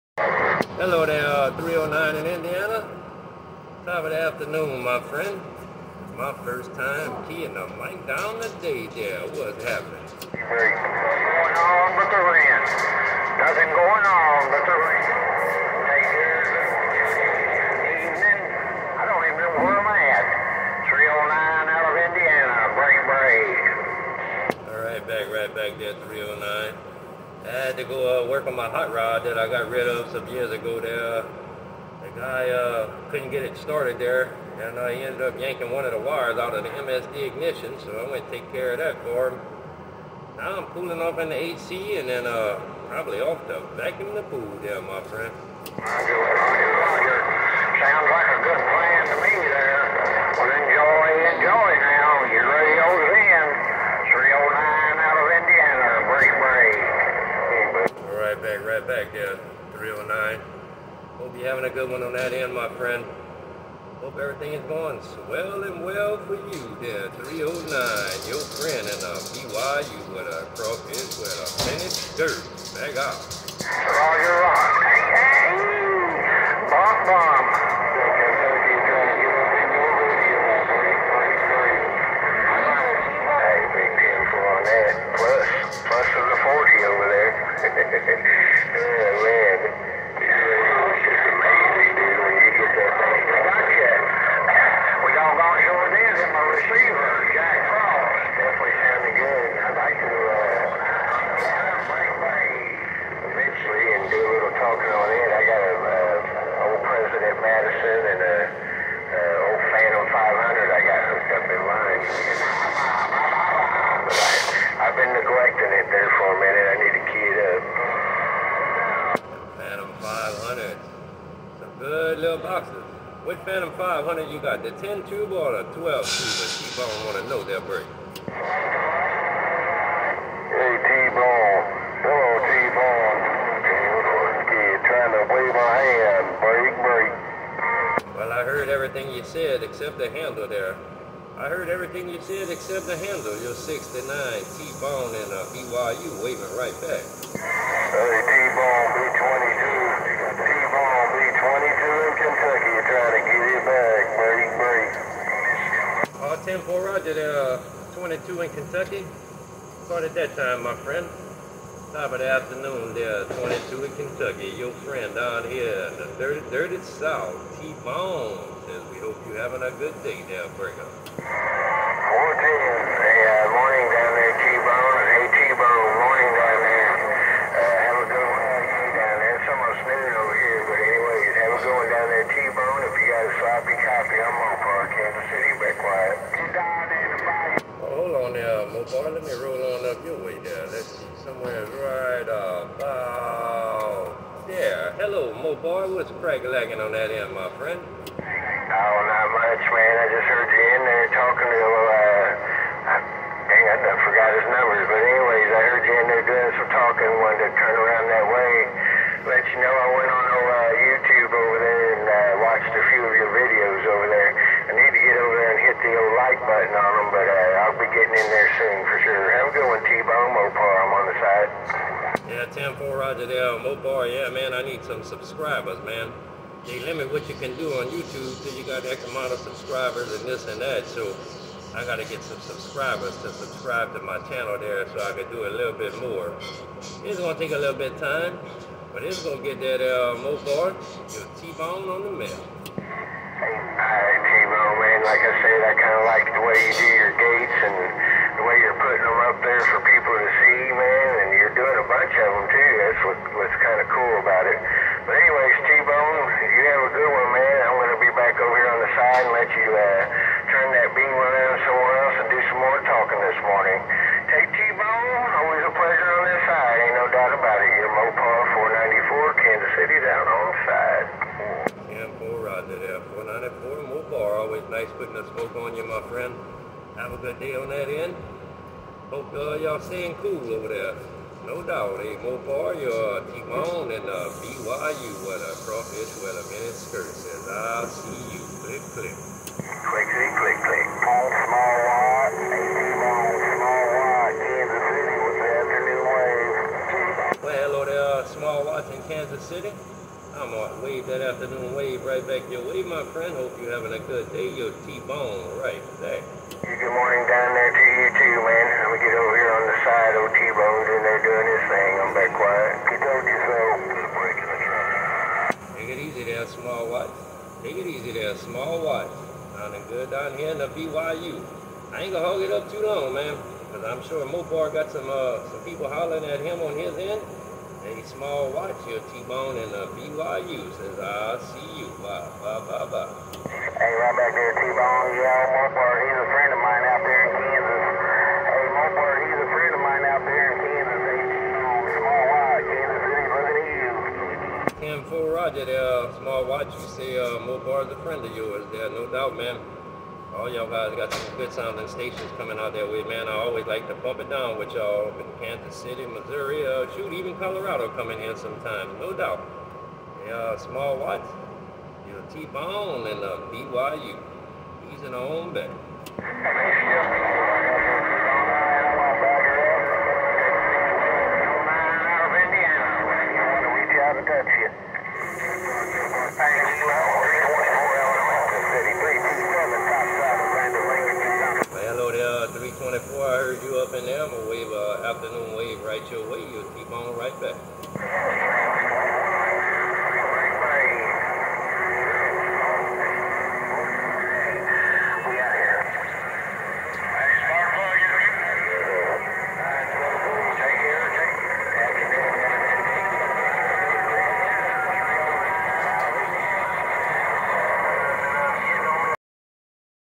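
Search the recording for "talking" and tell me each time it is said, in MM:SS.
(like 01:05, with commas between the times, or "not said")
03:21, 03:26, 04:22.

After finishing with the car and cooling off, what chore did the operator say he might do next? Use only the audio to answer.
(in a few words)
vacuum the pool.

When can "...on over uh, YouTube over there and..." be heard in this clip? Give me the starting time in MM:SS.
03:30.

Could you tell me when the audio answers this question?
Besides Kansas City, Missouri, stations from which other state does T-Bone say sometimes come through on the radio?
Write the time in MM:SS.
05:57.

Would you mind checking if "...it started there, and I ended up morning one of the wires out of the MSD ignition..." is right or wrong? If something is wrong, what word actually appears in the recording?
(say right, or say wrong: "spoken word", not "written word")
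wrong: "yanking", not "morning".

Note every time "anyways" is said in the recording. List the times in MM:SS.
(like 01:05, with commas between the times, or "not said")
03:24, 04:15.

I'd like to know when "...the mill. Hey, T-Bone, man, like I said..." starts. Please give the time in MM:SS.
04:02.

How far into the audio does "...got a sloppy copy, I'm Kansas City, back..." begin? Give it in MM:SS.
03:03.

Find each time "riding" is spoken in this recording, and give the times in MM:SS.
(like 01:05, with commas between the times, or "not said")
04:32.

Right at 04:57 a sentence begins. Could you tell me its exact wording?
Well, hello there, uh, Small Watts in Kansas City.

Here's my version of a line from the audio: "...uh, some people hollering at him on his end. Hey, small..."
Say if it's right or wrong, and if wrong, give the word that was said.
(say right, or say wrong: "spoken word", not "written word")
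right.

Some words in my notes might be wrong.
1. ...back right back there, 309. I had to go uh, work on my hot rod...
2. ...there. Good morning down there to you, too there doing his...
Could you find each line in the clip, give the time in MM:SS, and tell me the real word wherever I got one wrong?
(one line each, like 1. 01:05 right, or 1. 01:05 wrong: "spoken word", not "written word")
1. 00:25 right
2. 05:05 right.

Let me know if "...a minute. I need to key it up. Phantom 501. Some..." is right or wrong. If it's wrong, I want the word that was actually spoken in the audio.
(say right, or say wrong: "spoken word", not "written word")
wrong: "500", not "501".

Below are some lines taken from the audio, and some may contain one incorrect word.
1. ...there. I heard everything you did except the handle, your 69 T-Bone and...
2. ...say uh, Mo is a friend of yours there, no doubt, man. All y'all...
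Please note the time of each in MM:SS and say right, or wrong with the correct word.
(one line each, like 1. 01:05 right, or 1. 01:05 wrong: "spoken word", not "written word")
1. 02:20 right
2. 05:46 right.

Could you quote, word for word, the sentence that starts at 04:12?
That's what, what's kind of cool about it.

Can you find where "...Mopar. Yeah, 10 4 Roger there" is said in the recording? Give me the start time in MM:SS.
03:40.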